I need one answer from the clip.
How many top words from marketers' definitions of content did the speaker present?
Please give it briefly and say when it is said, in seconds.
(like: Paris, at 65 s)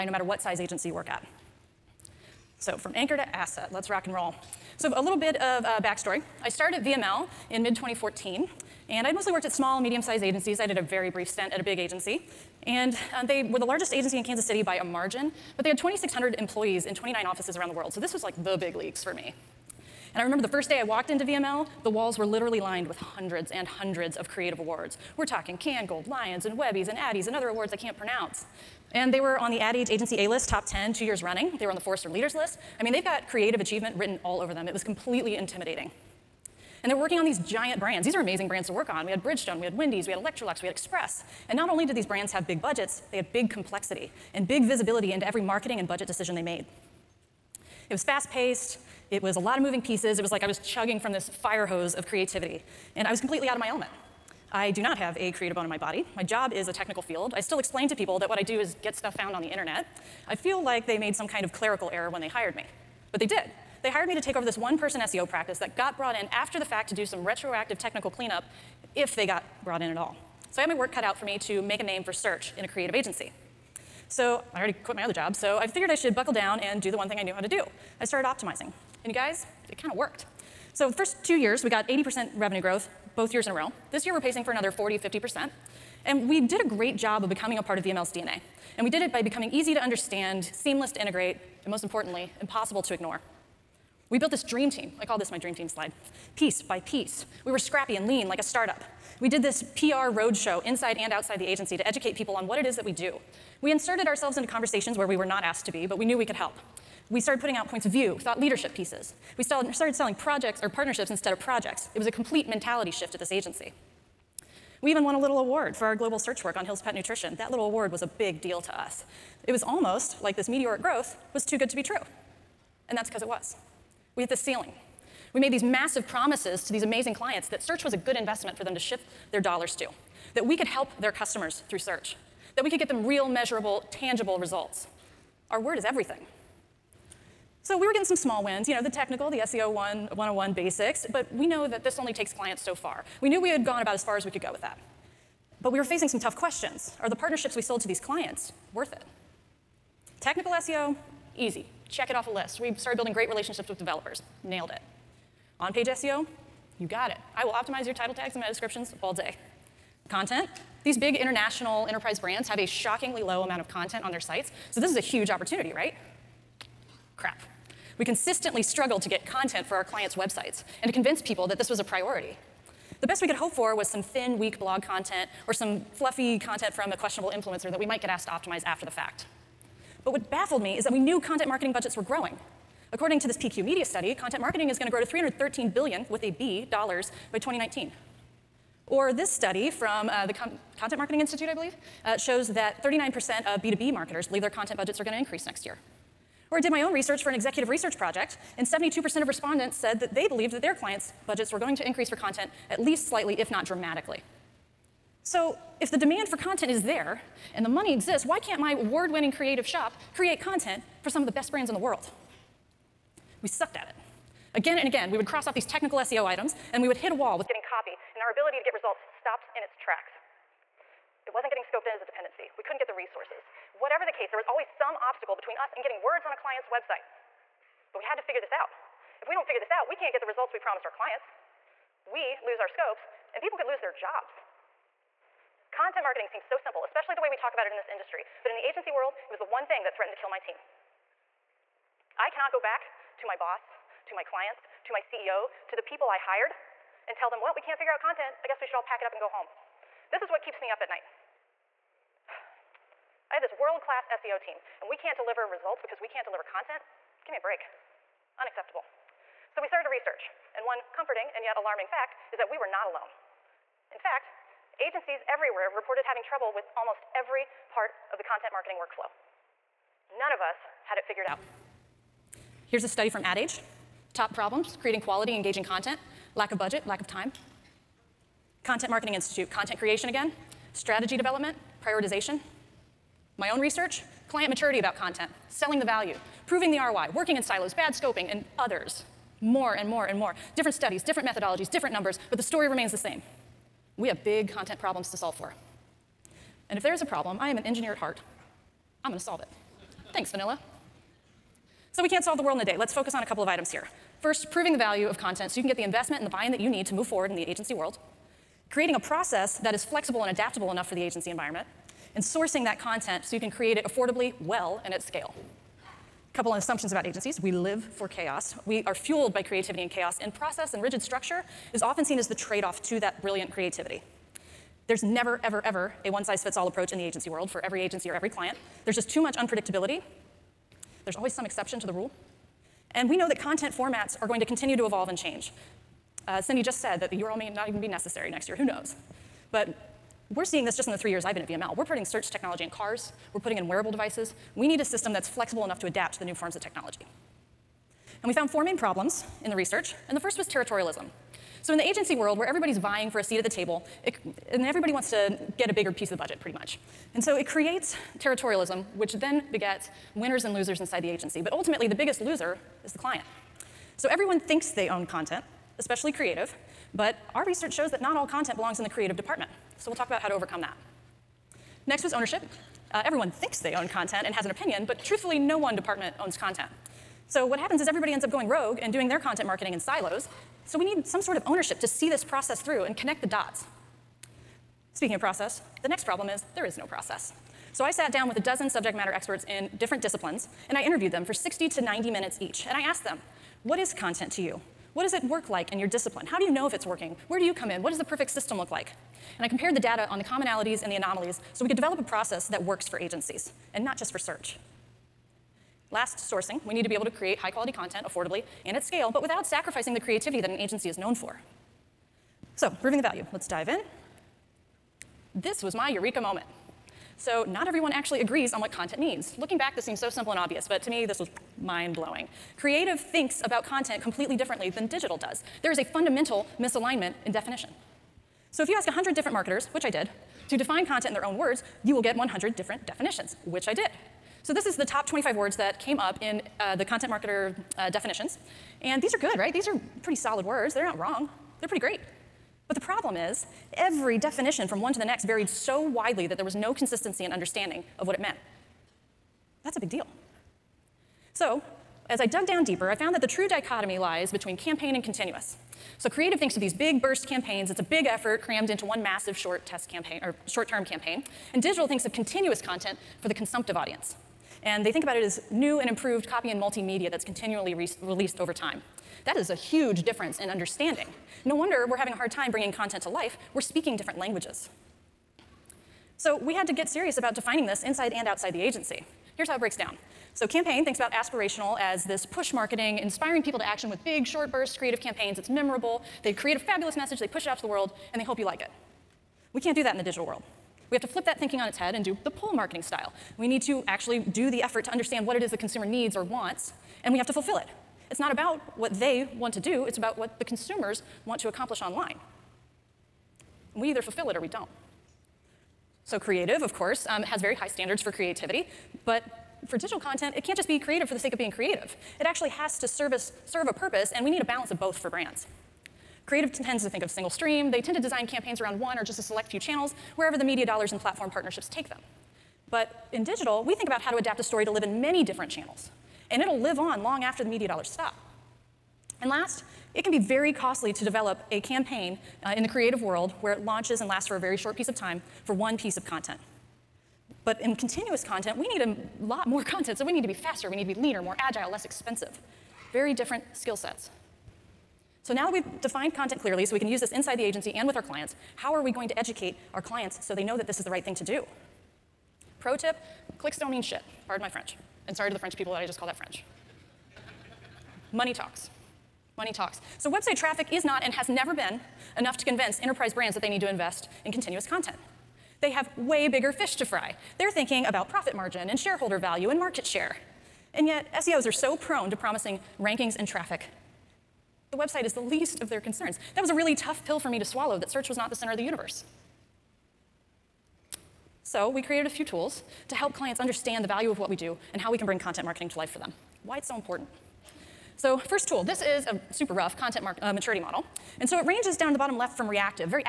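25, at 434 s.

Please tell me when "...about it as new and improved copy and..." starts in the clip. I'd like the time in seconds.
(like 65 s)
465 s.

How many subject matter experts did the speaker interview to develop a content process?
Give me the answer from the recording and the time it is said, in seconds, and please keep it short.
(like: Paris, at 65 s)
a dozen, at 388 s.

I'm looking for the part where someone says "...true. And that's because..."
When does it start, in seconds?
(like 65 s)
121 s.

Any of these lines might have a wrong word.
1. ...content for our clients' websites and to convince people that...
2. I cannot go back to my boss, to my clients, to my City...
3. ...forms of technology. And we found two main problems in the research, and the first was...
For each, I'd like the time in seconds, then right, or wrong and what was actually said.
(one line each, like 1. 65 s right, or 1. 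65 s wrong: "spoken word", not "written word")
1. 169 s right
2. 242 s wrong: "CEO", not "City"
3. 346 s wrong: "four", not "two".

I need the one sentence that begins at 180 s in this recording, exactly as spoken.
But what baffled me is that we knew content marketing budgets were growing.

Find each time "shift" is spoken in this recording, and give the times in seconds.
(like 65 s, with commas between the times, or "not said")
112 s, 128 s.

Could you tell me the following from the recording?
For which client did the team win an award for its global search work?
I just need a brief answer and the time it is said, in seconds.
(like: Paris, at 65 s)
Hill's Pet Nutrition, at 116 s.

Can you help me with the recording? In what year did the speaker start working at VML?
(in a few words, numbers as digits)
2014.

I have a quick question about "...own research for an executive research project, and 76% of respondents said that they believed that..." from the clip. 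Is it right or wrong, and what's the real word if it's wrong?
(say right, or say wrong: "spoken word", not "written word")
wrong: "72", not "76".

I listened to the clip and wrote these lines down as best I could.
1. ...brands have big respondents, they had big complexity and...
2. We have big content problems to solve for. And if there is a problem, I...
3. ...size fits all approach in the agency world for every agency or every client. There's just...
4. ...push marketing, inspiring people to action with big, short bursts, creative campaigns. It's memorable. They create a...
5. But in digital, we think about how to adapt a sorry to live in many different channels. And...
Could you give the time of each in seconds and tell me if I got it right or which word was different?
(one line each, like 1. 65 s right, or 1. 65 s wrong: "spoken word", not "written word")
1. 42 s wrong: "budgets", not "respondents"
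2. 293 s right
3. 326 s right
4. 482 s right
5. 522 s wrong: "story", not "sorry".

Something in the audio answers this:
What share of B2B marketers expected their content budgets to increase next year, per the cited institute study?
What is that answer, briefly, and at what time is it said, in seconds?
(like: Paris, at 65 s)
39%, at 192 s.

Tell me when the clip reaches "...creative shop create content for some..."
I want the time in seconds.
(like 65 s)
209 s.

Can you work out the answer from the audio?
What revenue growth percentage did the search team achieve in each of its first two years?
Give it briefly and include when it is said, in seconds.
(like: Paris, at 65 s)
80%, at 81 s.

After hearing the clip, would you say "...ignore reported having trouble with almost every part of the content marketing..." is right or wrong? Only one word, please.
wrong.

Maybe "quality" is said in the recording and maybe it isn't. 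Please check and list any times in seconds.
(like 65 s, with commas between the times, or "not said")
274 s, 407 s.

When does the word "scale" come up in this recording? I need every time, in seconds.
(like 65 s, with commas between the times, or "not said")
314 s, 408 s.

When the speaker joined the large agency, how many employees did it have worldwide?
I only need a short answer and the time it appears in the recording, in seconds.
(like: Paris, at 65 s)
2,600, at 15 s.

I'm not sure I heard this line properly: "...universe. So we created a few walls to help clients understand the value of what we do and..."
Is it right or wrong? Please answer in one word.
wrong.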